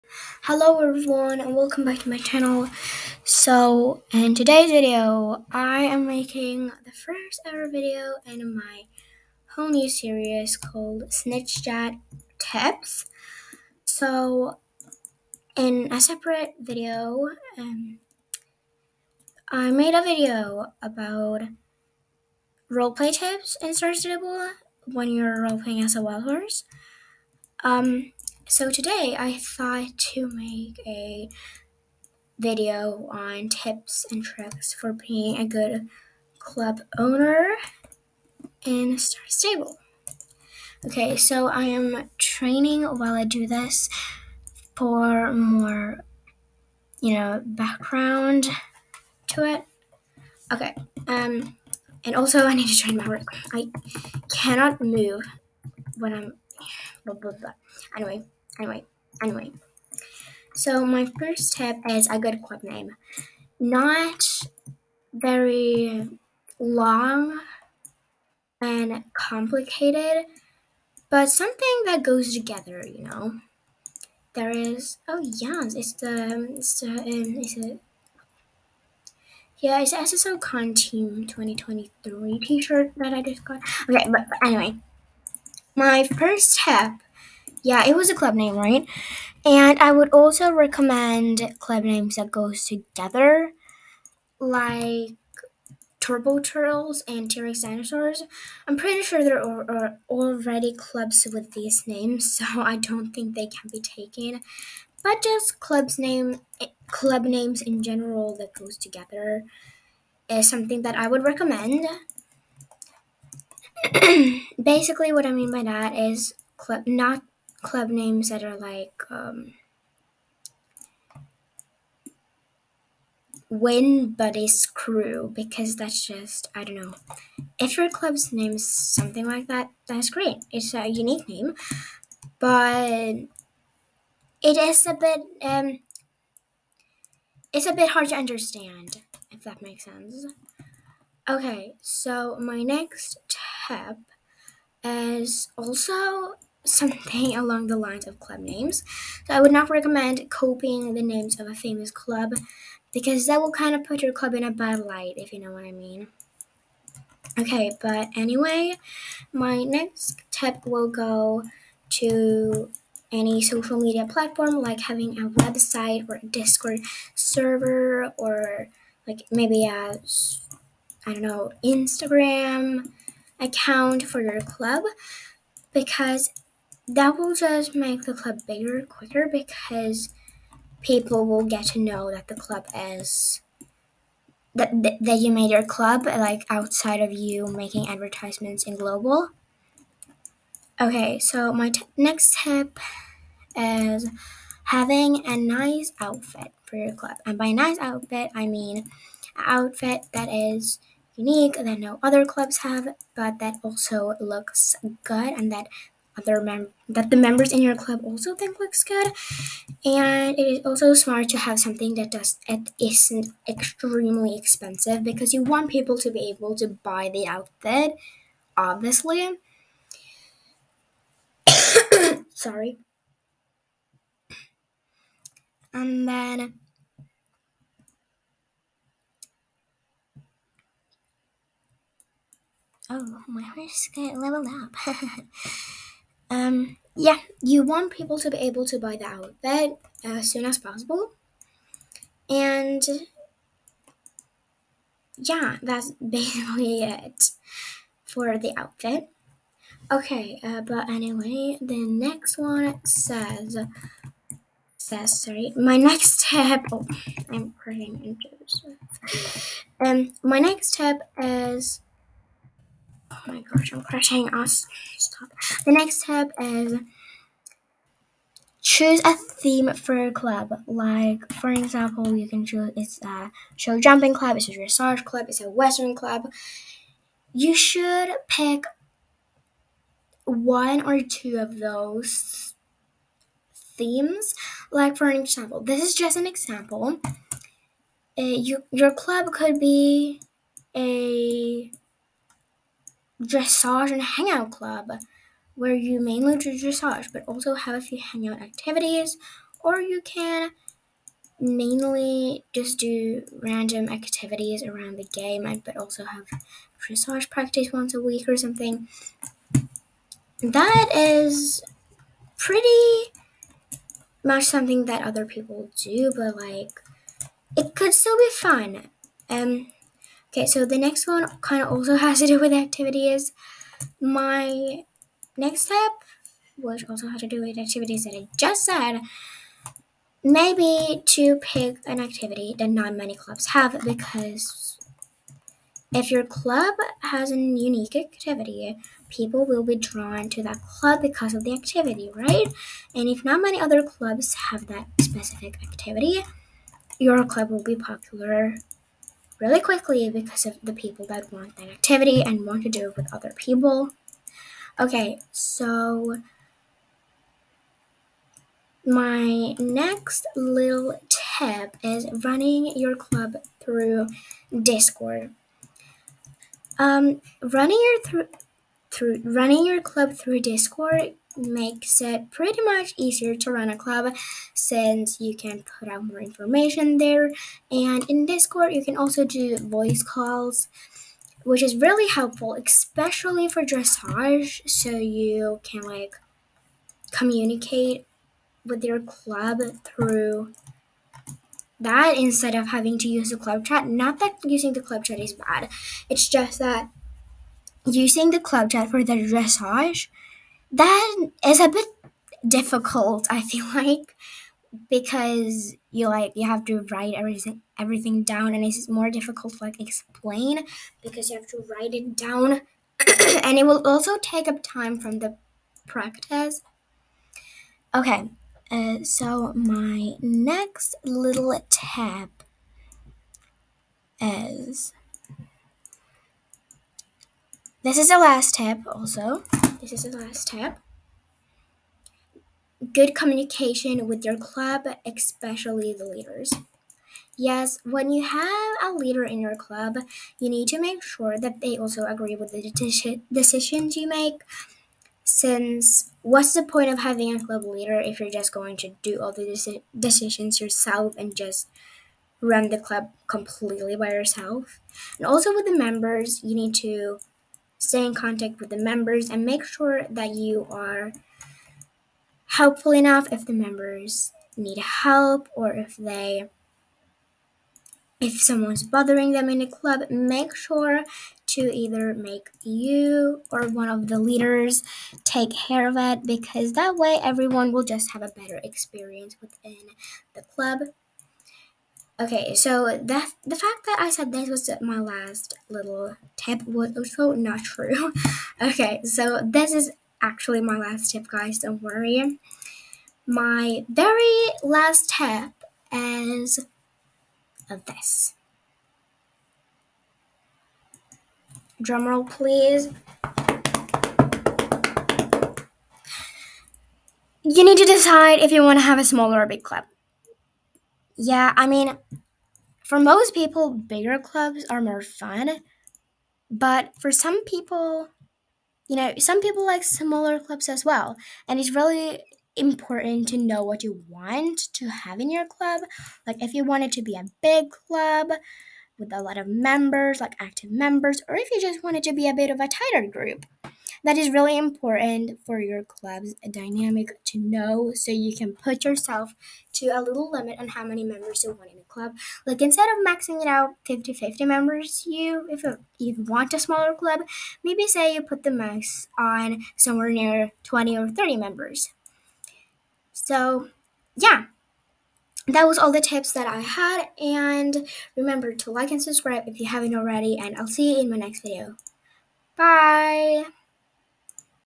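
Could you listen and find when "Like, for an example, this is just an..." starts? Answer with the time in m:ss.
4:44.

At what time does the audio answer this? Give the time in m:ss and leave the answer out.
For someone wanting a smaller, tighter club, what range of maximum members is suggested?
9:10.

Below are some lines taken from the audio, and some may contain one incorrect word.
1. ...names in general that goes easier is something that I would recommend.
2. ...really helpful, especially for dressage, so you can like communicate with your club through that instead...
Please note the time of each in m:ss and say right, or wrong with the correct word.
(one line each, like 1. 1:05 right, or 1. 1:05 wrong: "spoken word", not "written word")
1. 1:47 wrong: "together", not "easier"
2. 6:21 right.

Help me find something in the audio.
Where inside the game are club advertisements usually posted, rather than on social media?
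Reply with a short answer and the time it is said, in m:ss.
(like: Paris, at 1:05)
global, at 3:08.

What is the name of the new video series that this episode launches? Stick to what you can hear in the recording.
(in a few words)
Chit Chat Tips.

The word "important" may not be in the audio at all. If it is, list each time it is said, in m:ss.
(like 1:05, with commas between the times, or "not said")
8:42, 8:54.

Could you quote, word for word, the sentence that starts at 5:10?
That is pretty much something that other people do, but like it could still be fun.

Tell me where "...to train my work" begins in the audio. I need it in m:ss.
0:52.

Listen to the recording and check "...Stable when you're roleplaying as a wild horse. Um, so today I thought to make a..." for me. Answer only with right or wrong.
right.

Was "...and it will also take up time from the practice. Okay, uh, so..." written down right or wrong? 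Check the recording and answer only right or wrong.
right.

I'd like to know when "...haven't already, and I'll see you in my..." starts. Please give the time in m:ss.
9:19.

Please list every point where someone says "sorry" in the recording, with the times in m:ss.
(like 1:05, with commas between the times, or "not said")
3:42, 4:15.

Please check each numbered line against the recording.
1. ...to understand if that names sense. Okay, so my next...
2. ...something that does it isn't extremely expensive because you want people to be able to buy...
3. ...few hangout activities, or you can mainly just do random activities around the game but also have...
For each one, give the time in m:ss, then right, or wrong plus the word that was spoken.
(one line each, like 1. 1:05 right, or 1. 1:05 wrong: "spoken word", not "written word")
1. 2:18 wrong: "makes", not "names"
2. 3:31 right
3. 4:57 right.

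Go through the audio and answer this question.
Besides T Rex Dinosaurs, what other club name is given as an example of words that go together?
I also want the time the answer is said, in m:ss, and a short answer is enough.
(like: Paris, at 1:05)
Turbo Turtles, at 1:35.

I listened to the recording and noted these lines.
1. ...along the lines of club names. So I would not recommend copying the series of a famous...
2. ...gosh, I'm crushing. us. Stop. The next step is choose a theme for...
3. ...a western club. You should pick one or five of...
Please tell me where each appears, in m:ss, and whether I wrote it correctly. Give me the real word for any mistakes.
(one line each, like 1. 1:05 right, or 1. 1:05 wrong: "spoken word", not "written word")
1. 2:27 wrong: "names", not "series"
2. 4:23 right
3. 4:35 wrong: "two", not "five".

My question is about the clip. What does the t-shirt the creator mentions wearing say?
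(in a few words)
SSO Con Team 2023.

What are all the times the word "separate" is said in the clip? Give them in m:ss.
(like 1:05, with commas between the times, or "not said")
0:16.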